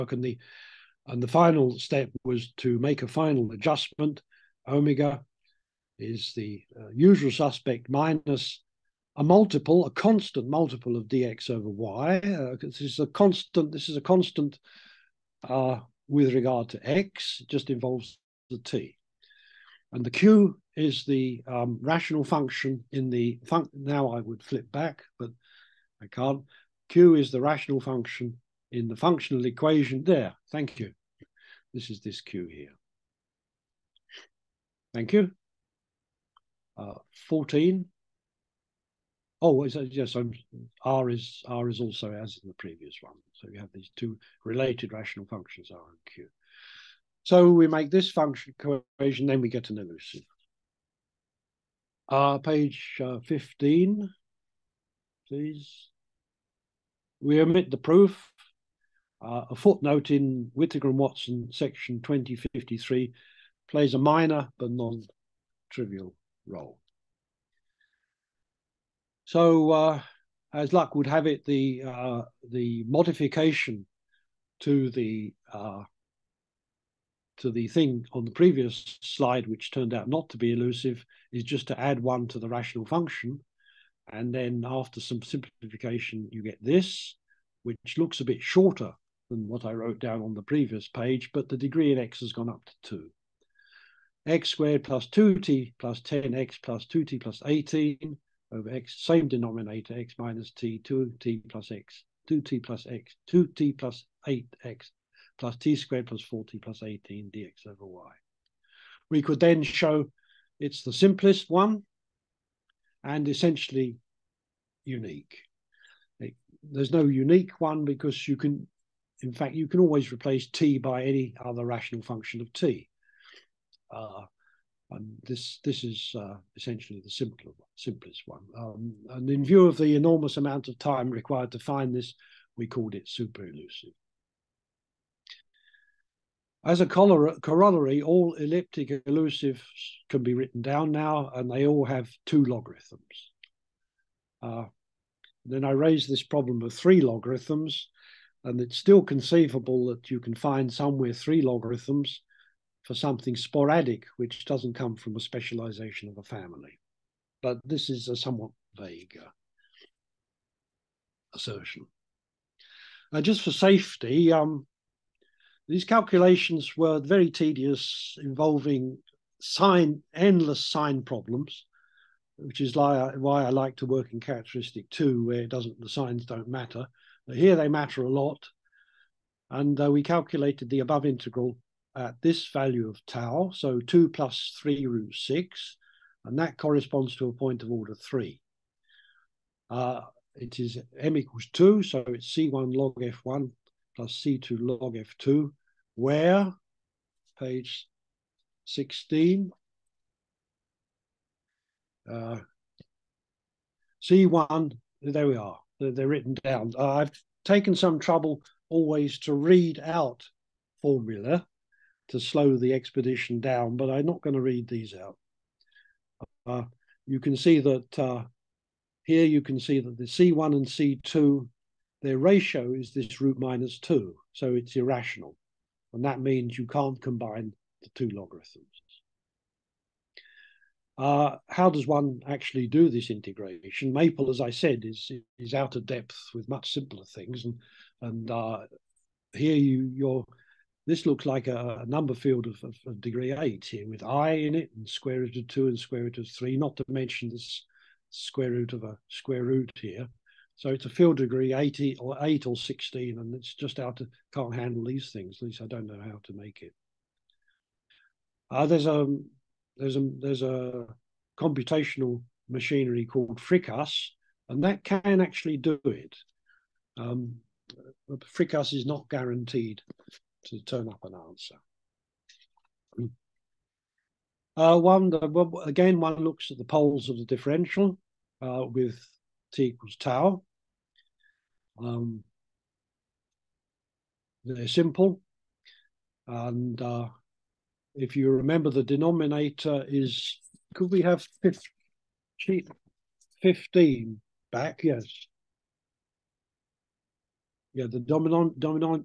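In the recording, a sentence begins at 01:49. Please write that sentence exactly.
We could then show it's the simplest one and essentially unique.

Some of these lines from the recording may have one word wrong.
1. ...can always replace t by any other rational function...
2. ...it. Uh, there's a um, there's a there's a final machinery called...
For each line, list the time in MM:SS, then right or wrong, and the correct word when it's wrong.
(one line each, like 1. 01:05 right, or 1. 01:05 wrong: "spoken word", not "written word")
1. 01:59 right
2. 04:16 wrong: "computational", not "final".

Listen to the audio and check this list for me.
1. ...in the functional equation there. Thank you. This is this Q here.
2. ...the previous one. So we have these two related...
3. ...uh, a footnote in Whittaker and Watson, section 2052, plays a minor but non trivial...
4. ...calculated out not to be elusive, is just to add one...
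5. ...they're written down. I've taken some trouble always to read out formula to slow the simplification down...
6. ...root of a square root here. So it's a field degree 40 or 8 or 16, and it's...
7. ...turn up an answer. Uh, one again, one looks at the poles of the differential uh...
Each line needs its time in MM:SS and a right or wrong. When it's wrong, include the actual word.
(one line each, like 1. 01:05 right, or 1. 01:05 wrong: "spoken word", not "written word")
1. 00:28 right
2. 00:42 right
3. 00:59 wrong: "2053", not "2052"
4. 01:19 wrong: "turned", not "calculated"
5. 03:25 wrong: "expedition", not "simplification"
6. 04:08 wrong: "80", not "40"
7. 04:30 right.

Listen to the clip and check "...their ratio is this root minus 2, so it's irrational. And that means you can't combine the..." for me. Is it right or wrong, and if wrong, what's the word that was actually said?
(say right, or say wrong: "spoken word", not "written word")
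right.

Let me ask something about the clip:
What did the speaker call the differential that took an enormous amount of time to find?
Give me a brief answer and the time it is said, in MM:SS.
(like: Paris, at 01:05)
super elusive, at 02:13.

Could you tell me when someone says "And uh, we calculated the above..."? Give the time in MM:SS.
02:59.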